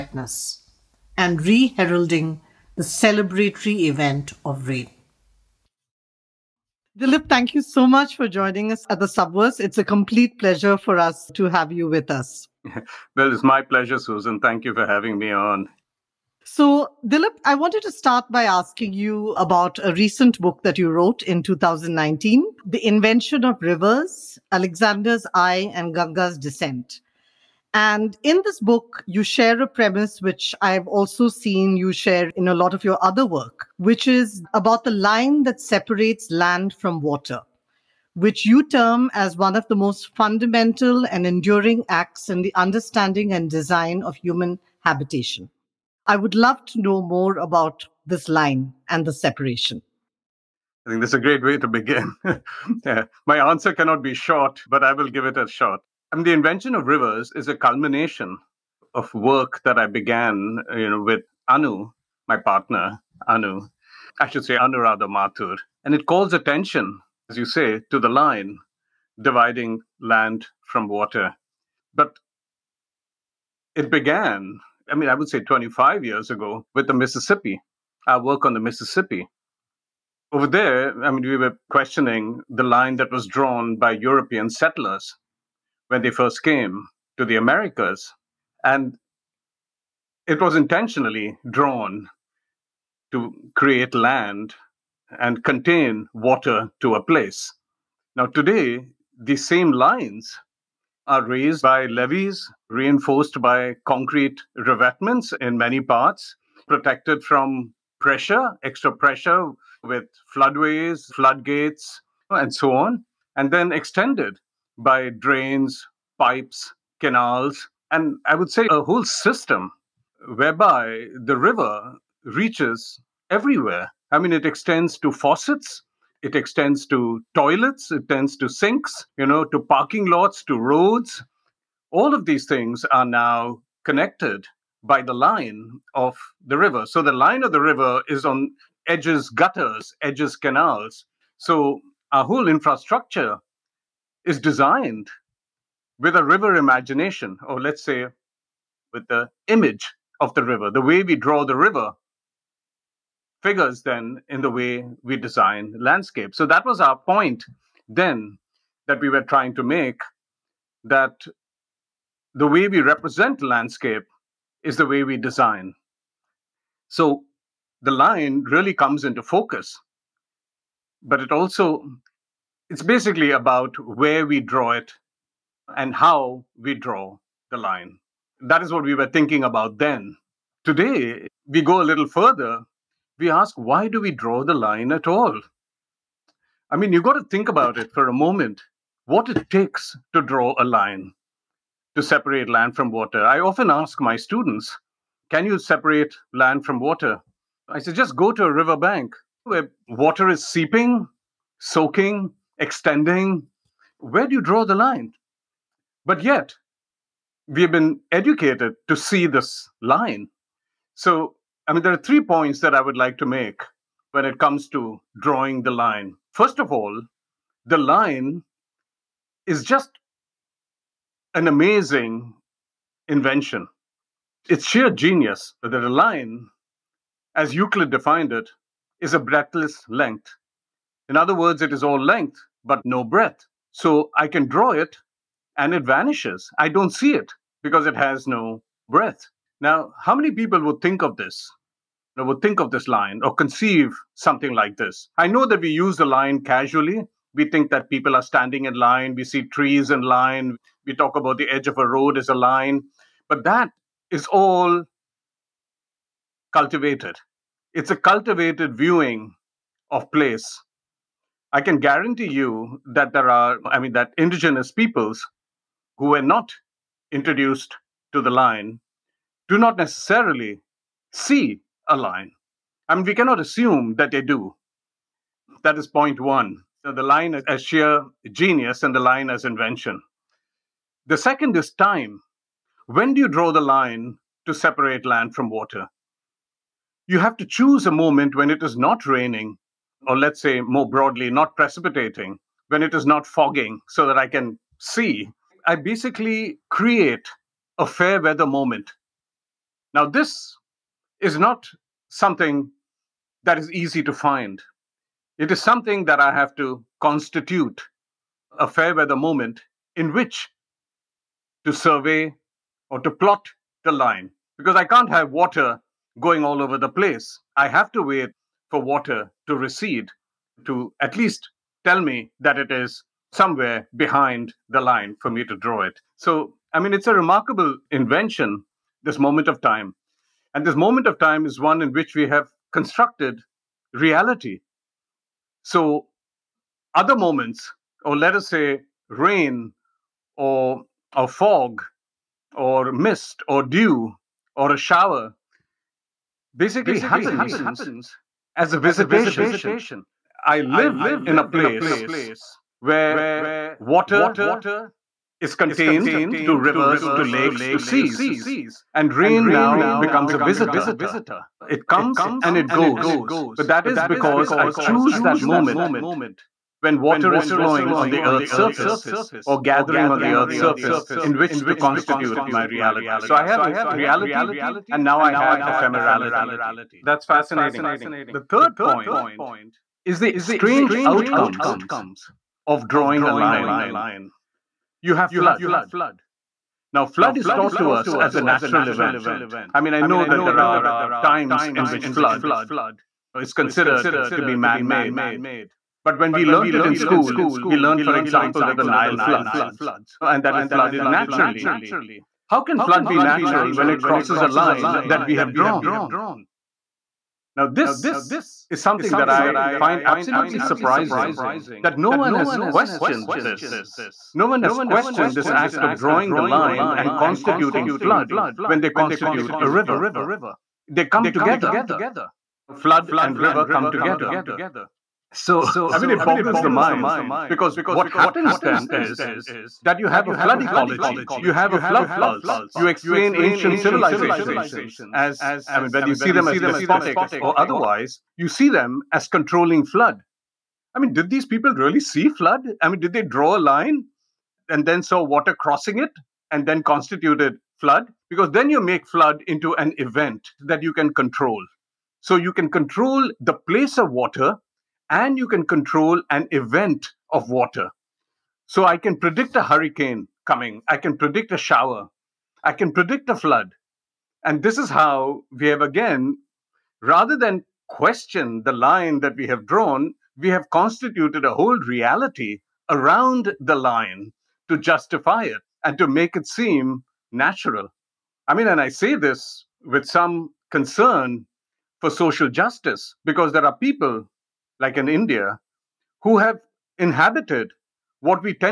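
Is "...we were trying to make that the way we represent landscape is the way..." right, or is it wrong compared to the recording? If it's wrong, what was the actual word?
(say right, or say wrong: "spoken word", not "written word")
right.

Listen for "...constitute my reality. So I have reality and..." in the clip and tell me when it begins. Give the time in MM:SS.
06:11.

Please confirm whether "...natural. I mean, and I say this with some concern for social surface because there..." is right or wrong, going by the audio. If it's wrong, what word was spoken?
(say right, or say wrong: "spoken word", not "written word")
wrong: "justice", not "surface".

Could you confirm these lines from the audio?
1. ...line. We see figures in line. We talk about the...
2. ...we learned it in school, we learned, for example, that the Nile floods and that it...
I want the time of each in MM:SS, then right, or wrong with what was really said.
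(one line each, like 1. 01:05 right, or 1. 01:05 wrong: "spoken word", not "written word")
1. 04:08 wrong: "trees", not "figures"
2. 06:36 right.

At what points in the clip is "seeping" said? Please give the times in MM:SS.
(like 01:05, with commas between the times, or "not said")
03:20.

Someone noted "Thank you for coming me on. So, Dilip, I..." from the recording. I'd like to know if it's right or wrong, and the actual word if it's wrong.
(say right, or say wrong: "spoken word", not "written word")
wrong: "having", not "coming".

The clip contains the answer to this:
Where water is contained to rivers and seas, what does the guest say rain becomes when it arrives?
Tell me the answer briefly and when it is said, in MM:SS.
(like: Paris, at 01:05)
a visitor, at 06:00.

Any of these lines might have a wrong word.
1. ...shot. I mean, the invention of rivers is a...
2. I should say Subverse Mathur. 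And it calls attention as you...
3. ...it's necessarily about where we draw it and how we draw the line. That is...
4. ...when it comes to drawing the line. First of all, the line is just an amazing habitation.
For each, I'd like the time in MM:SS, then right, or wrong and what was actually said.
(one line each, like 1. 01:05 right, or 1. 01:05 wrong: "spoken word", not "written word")
1. 00:55 right
2. 01:04 wrong: "Anuradha", not "Subverse"
3. 02:52 wrong: "basically", not "necessarily"
4. 03:34 wrong: "invention", not "habitation".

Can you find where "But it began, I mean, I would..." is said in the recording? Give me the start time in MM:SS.
01:11.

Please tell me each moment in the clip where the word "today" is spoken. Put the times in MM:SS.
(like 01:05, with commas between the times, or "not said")
01:38, 03:00.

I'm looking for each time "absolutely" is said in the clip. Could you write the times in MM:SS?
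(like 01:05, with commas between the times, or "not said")
06:50.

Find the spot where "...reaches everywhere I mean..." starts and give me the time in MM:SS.
02:02.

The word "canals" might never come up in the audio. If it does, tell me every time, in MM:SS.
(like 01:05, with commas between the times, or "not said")
01:57, 02:20.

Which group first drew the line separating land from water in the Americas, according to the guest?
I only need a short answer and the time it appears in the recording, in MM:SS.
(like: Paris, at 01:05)
European settlers, at 01:23.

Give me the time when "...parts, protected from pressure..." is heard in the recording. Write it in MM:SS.
01:45.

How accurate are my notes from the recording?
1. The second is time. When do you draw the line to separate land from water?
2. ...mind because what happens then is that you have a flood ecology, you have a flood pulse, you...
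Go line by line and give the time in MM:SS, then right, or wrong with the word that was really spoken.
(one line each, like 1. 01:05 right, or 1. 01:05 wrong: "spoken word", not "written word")
1. 04:41 right
2. 07:06 right.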